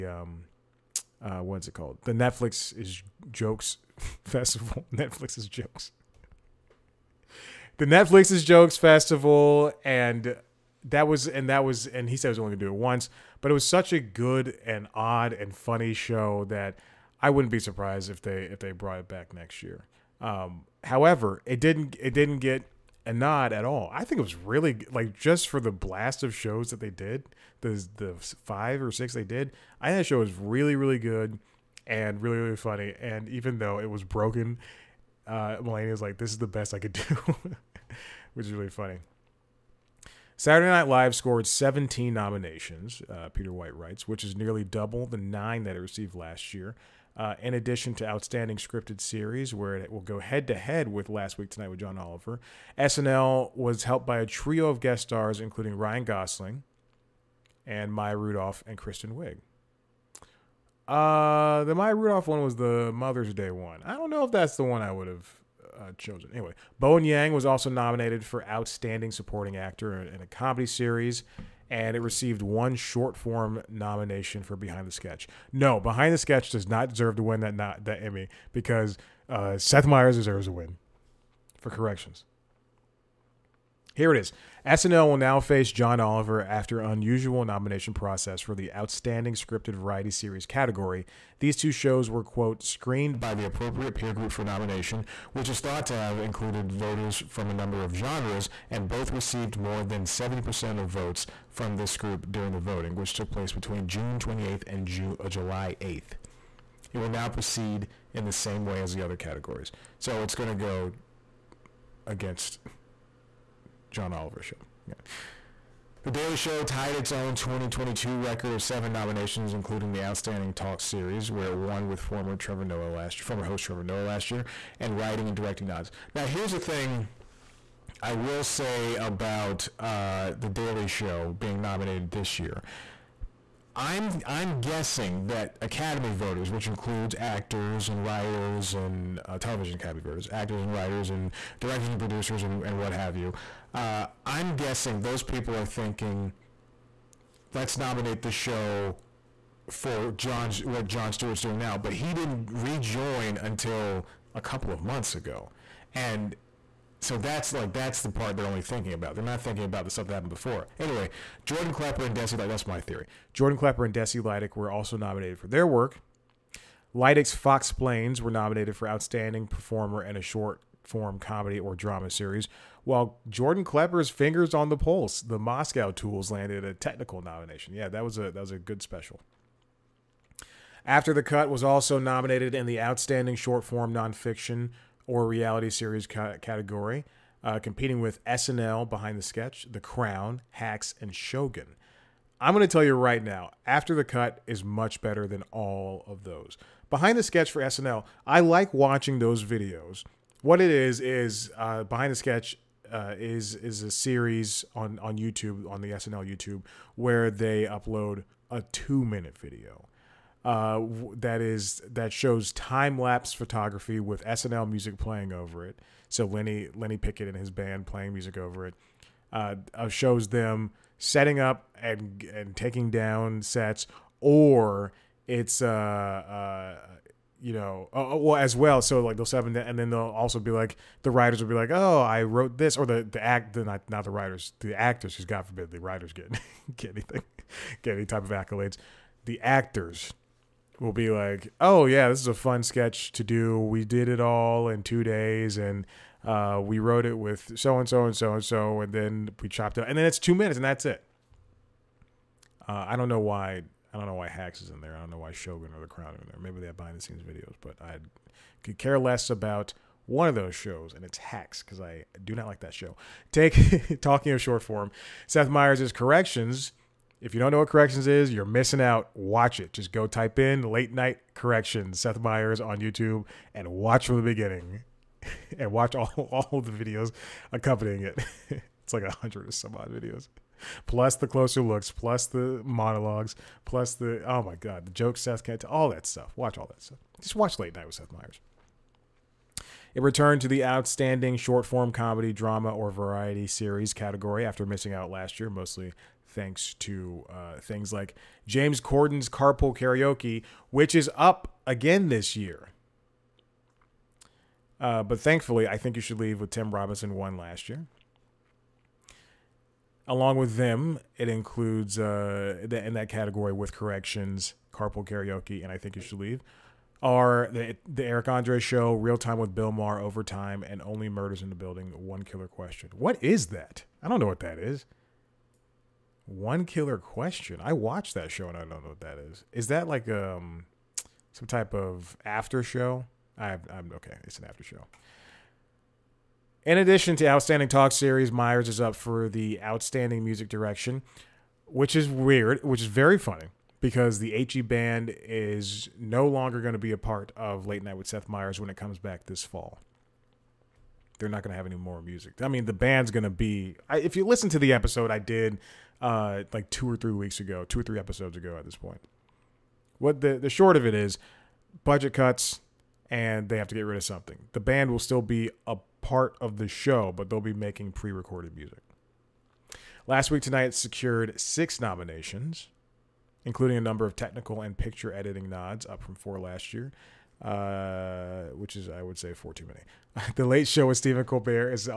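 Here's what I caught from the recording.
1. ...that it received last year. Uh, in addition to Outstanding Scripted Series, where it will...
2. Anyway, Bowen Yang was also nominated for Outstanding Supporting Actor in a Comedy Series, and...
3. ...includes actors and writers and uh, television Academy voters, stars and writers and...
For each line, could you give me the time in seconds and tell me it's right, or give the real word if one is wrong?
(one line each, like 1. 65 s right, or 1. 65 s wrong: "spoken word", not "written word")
1. 45 s right
2. 66 s right
3. 136 s wrong: "actors", not "stars".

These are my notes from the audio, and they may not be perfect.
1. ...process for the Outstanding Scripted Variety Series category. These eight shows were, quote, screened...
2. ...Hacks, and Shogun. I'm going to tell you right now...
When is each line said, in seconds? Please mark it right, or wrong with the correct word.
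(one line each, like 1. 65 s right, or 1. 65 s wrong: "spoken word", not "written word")
1. 87 s wrong: "two", not "eight"
2. 190 s right.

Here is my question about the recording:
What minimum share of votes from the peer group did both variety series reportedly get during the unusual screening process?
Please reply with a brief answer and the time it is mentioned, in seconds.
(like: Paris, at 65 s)
70%, at 100 s.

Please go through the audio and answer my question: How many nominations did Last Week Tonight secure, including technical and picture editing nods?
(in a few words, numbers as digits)
6.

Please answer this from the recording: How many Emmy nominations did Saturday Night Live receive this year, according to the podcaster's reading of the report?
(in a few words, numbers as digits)
17.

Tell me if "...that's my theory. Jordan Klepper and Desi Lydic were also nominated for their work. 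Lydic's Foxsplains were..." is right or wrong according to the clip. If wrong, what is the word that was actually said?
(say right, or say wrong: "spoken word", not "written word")
right.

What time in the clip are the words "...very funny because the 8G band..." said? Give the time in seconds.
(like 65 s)
342 s.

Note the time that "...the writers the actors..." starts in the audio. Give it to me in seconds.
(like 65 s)
234 s.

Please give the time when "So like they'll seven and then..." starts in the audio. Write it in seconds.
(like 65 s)
228 s.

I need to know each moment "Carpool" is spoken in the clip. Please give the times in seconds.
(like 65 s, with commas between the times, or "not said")
299 s, 314 s.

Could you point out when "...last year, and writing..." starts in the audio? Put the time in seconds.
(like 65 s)
124 s.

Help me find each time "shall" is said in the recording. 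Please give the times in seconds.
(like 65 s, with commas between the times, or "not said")
not said.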